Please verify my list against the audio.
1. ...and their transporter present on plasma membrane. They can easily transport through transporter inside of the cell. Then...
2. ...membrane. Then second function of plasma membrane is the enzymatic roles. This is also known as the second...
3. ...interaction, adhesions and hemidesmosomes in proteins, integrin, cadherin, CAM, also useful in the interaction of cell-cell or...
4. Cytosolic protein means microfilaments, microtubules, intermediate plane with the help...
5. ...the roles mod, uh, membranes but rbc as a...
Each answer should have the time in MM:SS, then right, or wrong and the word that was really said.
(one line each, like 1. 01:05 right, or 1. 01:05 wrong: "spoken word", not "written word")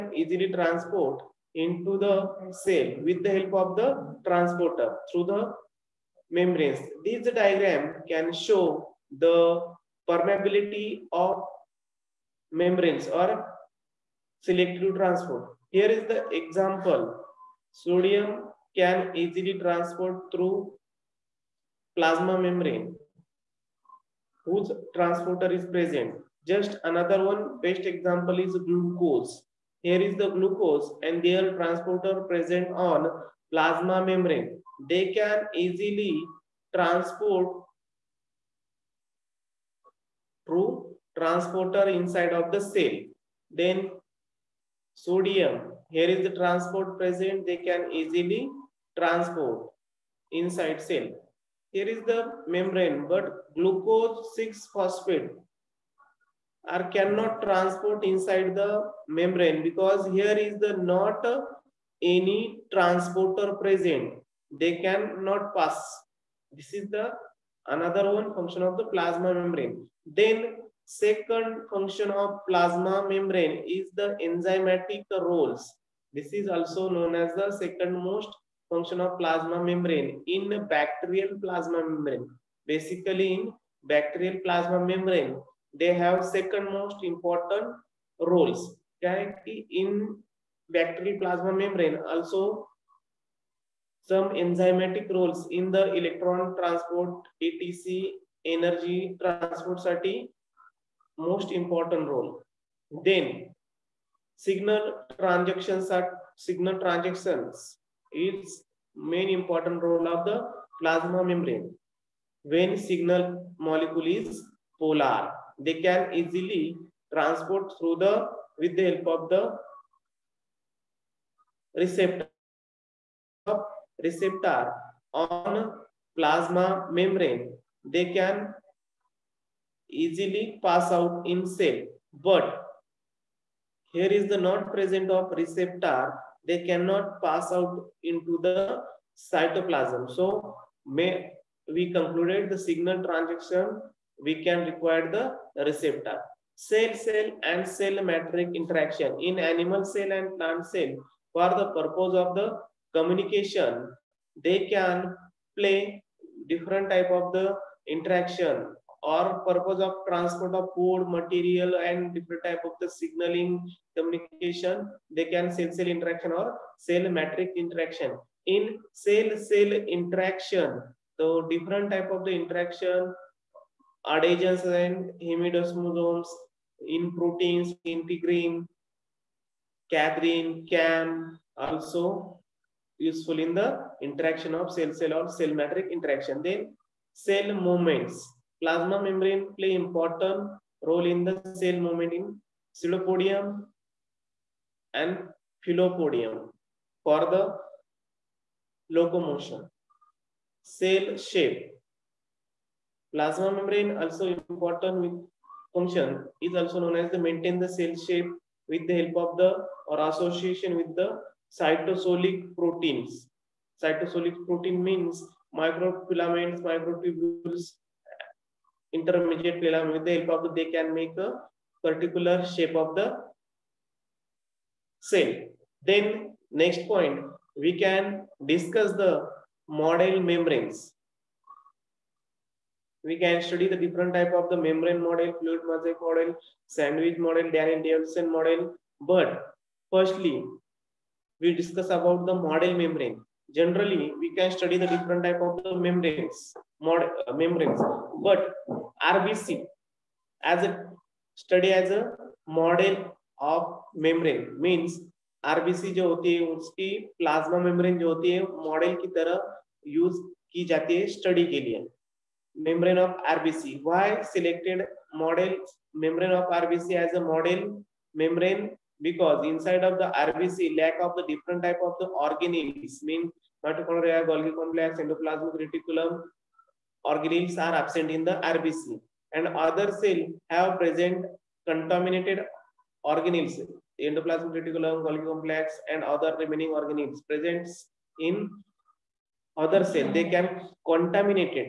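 1. 00:31 right
2. 01:09 right
3. 02:52 right
4. 03:33 right
5. 04:05 wrong: "membranes", not "roles".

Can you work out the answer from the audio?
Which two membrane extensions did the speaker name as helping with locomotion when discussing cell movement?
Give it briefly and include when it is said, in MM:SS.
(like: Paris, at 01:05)
Pseudopodium and filopodium, at 03:12.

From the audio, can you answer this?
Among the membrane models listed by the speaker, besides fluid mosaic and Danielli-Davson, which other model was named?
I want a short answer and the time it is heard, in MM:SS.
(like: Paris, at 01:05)
Sandwich model, at 03:56.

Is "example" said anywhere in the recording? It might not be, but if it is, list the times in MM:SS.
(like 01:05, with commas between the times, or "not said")
00:16, 00:27.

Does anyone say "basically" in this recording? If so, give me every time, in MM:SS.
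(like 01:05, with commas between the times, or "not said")
01:22.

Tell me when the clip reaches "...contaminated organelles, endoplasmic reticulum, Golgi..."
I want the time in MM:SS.
04:41.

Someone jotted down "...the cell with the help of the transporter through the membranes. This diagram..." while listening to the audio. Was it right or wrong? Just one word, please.
right.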